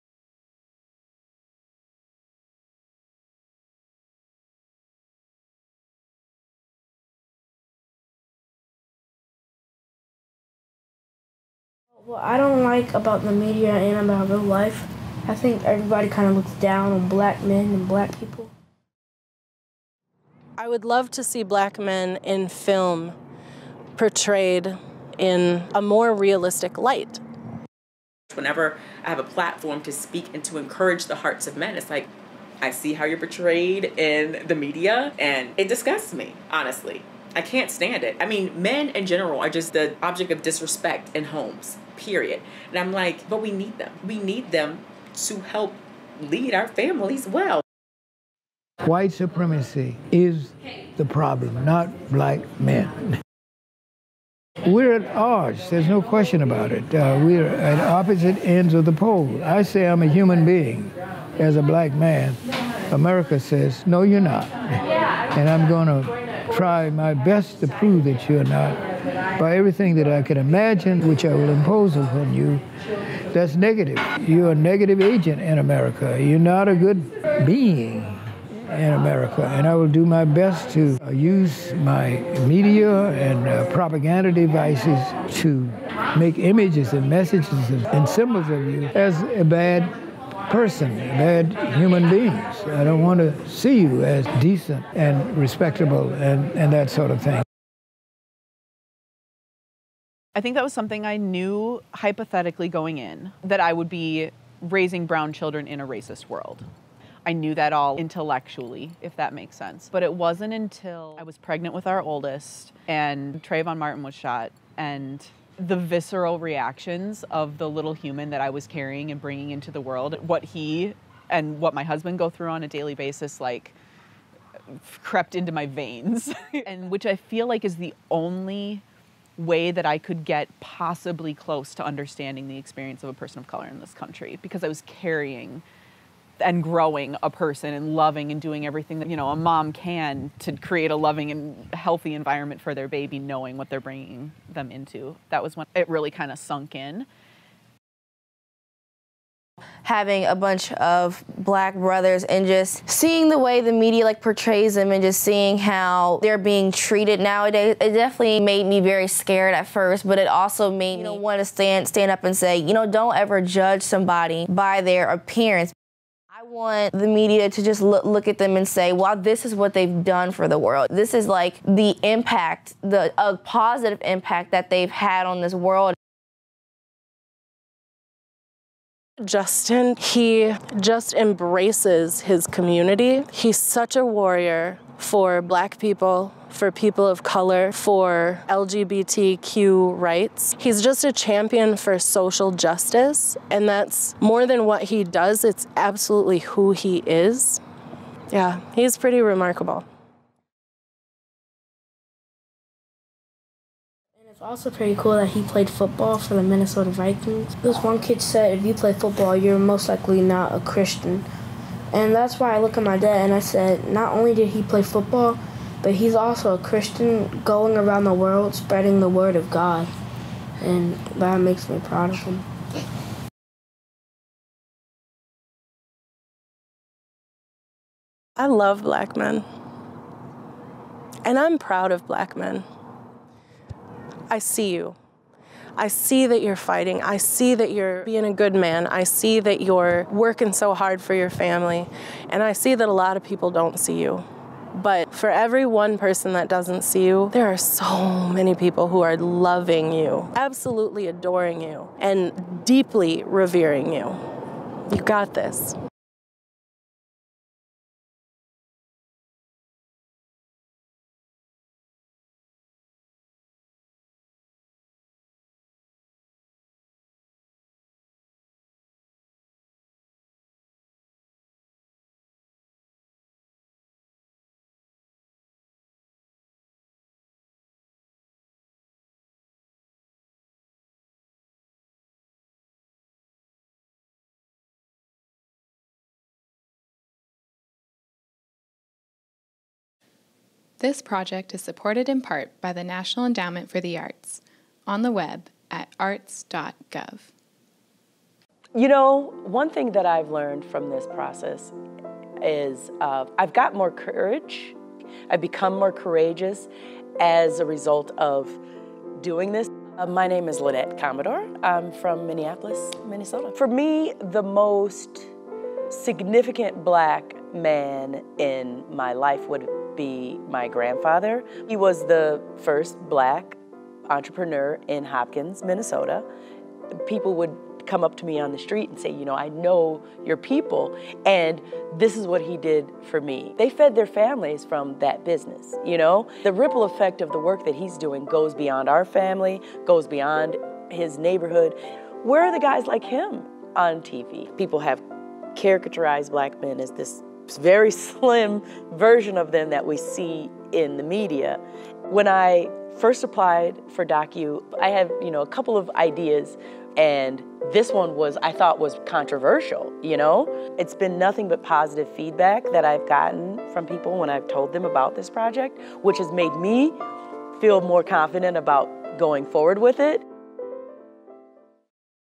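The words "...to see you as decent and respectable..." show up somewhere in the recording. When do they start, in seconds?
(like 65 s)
93 s.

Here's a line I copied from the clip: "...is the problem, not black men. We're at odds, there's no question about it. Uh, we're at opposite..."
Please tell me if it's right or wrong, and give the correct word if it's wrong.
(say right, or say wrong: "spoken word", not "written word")
right.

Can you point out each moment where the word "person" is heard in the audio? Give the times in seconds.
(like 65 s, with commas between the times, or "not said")
90 s, 133 s, 137 s, 245 s.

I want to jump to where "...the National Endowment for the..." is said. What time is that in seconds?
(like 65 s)
292 s.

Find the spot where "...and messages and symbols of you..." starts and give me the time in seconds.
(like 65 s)
86 s.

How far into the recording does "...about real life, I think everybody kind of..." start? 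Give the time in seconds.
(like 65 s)
14 s.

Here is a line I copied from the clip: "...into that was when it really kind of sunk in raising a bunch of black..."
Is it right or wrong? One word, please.
wrong.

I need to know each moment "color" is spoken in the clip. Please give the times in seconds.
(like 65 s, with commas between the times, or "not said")
133 s, 187 s.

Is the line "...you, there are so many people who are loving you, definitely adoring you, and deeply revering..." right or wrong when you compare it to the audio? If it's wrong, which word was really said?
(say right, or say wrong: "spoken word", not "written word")
wrong: "absolutely", not "definitely".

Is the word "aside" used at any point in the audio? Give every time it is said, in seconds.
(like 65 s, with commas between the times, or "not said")
not said.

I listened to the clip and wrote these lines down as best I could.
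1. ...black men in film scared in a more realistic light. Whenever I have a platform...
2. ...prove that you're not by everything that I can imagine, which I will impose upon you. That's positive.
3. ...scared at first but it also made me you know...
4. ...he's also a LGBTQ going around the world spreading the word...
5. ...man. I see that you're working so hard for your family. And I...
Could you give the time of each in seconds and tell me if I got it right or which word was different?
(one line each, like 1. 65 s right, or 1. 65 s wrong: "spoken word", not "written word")
1. 21 s wrong: "portrayed", not "scared"
2. 67 s wrong: "negative", not "positive"
3. 159 s right
4. 215 s wrong: "Christian", not "LGBTQ"
5. 238 s right.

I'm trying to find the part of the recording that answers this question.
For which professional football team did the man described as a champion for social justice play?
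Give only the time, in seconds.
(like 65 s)
206 s.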